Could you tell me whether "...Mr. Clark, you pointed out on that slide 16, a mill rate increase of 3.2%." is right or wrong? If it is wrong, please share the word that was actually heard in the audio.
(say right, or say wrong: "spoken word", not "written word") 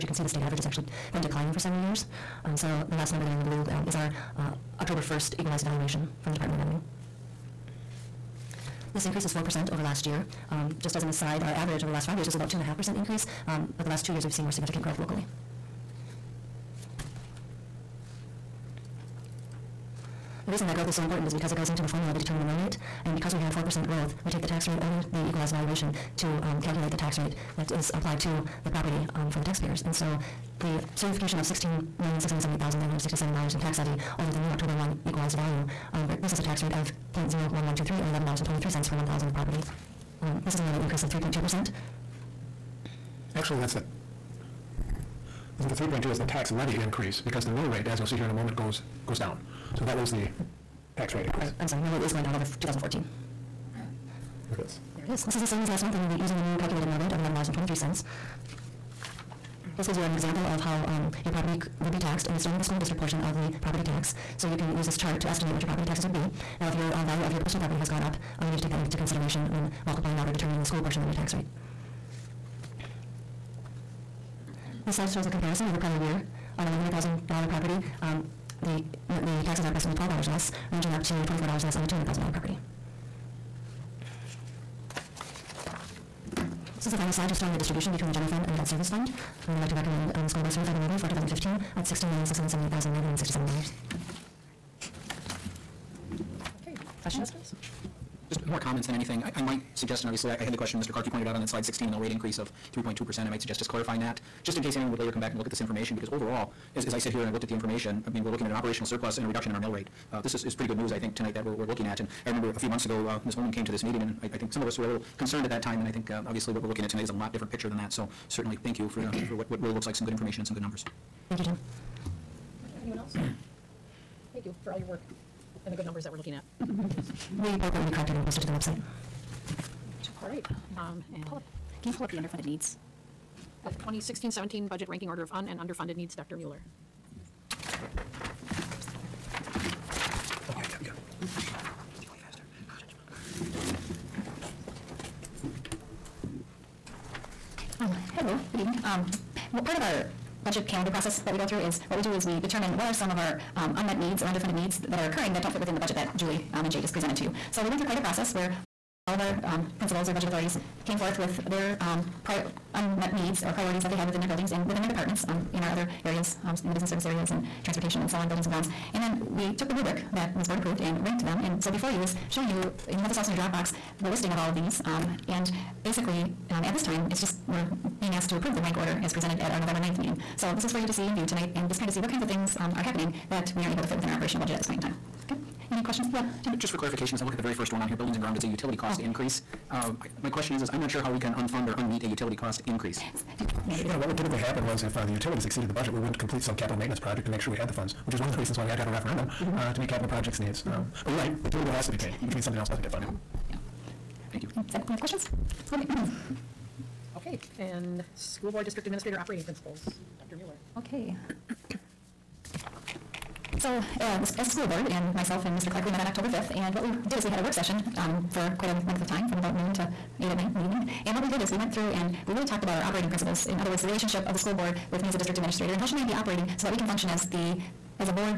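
right.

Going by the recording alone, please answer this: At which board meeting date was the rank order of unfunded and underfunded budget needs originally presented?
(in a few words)
November 9th.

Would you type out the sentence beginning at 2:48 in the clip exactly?
And then we took the rubric that was board approved and ranked them.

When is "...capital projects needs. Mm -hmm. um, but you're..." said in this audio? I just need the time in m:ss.
3:19.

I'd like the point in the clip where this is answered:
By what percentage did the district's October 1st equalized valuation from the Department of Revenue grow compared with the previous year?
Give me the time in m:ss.
0:09.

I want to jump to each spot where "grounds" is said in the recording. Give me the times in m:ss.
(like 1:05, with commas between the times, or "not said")
2:48, 3:08.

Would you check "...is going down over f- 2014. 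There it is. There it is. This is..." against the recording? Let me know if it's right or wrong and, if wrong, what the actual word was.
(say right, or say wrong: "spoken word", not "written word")
right.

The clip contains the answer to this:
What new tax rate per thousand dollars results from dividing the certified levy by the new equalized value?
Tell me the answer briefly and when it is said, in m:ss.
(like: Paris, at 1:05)
$11.23, at 0:38.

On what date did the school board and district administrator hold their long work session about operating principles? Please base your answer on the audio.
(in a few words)
October 5th.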